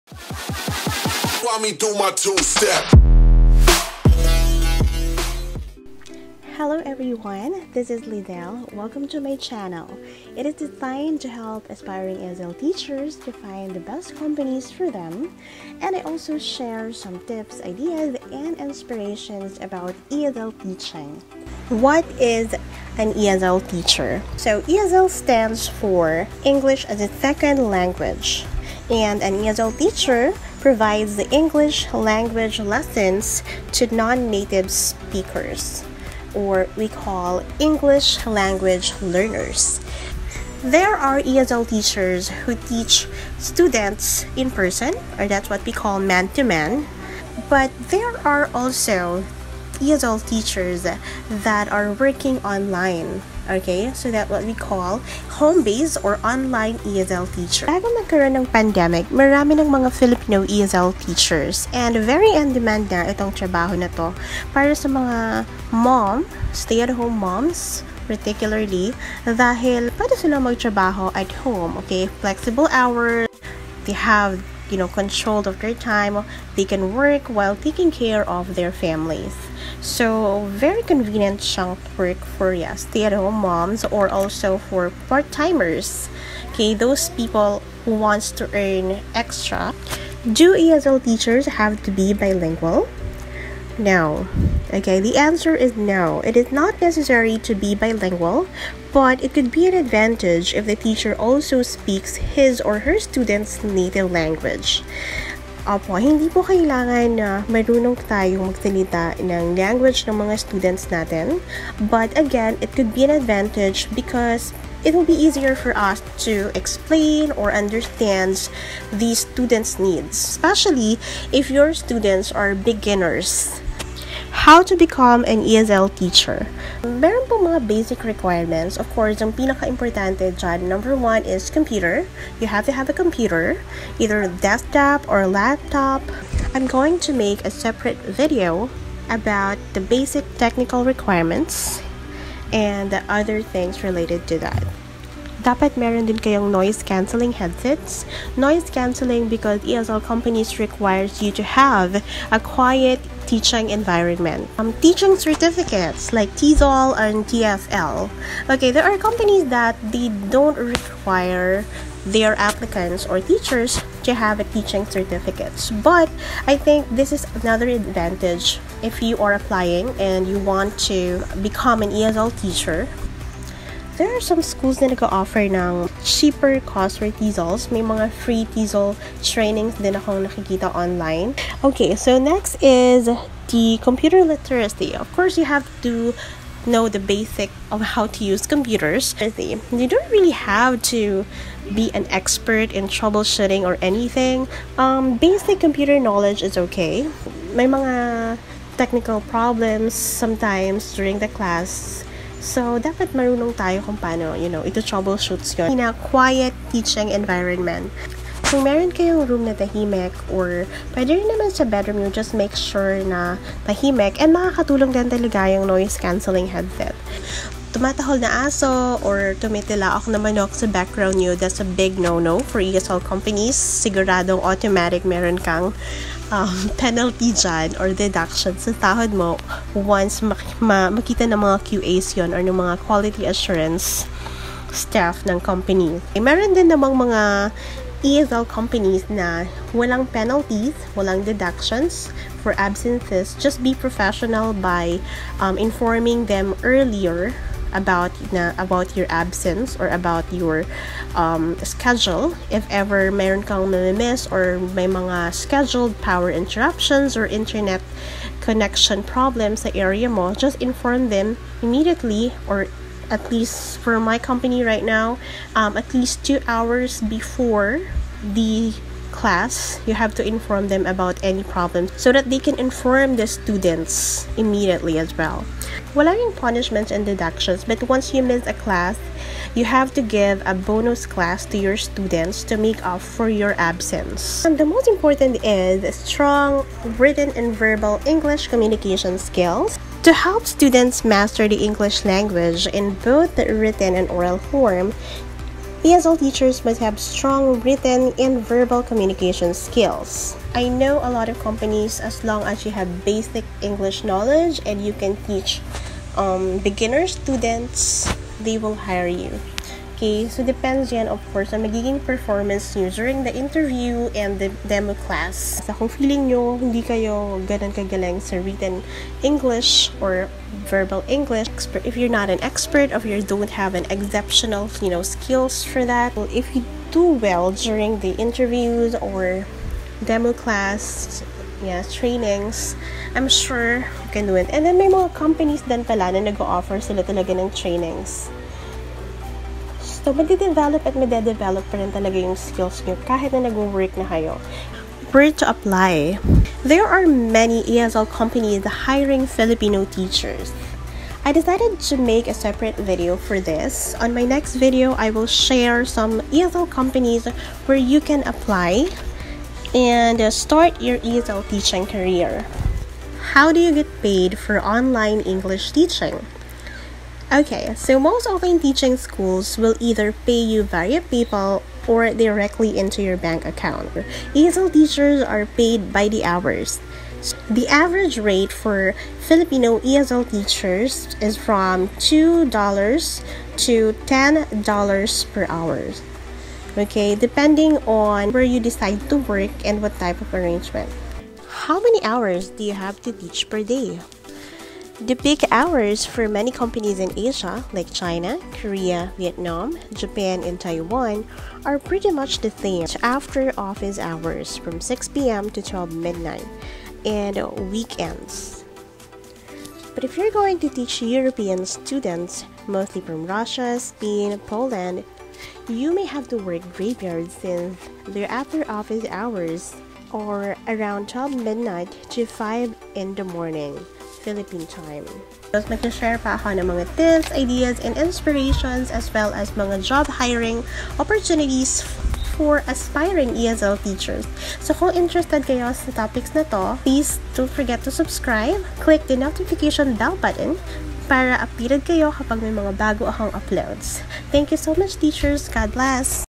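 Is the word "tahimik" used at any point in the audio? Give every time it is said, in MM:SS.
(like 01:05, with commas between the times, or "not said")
03:29, 03:33.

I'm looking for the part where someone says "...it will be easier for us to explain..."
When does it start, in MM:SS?
01:54.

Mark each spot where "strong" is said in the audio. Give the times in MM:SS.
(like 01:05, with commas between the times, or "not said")
04:45, 04:57.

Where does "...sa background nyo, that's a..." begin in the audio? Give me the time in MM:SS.
03:40.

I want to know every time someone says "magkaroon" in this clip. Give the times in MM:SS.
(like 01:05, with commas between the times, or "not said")
00:57.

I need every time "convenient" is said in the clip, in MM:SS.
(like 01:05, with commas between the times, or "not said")
01:20.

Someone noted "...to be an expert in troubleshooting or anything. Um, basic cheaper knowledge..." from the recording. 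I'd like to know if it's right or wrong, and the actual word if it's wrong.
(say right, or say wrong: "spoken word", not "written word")
wrong: "computer", not "cheaper".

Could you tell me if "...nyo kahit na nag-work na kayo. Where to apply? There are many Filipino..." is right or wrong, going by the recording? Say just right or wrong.
wrong.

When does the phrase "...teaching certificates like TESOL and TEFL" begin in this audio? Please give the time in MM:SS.
02:34.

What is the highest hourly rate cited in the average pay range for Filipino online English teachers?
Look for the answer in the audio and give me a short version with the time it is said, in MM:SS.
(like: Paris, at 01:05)
$10, at 06:22.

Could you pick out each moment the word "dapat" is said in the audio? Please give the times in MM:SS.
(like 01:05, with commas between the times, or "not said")
02:25, 03:22.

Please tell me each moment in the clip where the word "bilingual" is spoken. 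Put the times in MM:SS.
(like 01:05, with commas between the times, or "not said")
01:32, 01:37.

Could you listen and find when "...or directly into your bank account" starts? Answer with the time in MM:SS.
06:11.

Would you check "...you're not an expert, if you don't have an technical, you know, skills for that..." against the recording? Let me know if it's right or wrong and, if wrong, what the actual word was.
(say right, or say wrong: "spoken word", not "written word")
wrong: "exceptional", not "technical".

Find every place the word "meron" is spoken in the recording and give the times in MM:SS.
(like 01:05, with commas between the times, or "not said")
02:06, 02:25, 03:28, 03:45, 03:56.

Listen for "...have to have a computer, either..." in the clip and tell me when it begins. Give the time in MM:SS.
02:12.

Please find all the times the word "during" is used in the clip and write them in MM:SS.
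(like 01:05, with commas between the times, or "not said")
03:20, 05:12, 05:27.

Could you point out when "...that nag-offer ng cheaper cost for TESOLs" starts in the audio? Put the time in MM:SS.
02:54.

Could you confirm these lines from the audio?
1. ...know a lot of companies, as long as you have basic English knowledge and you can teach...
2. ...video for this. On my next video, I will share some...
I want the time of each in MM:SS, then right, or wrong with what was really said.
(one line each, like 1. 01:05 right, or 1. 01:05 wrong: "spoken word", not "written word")
1. 05:00 right
2. 05:52 right.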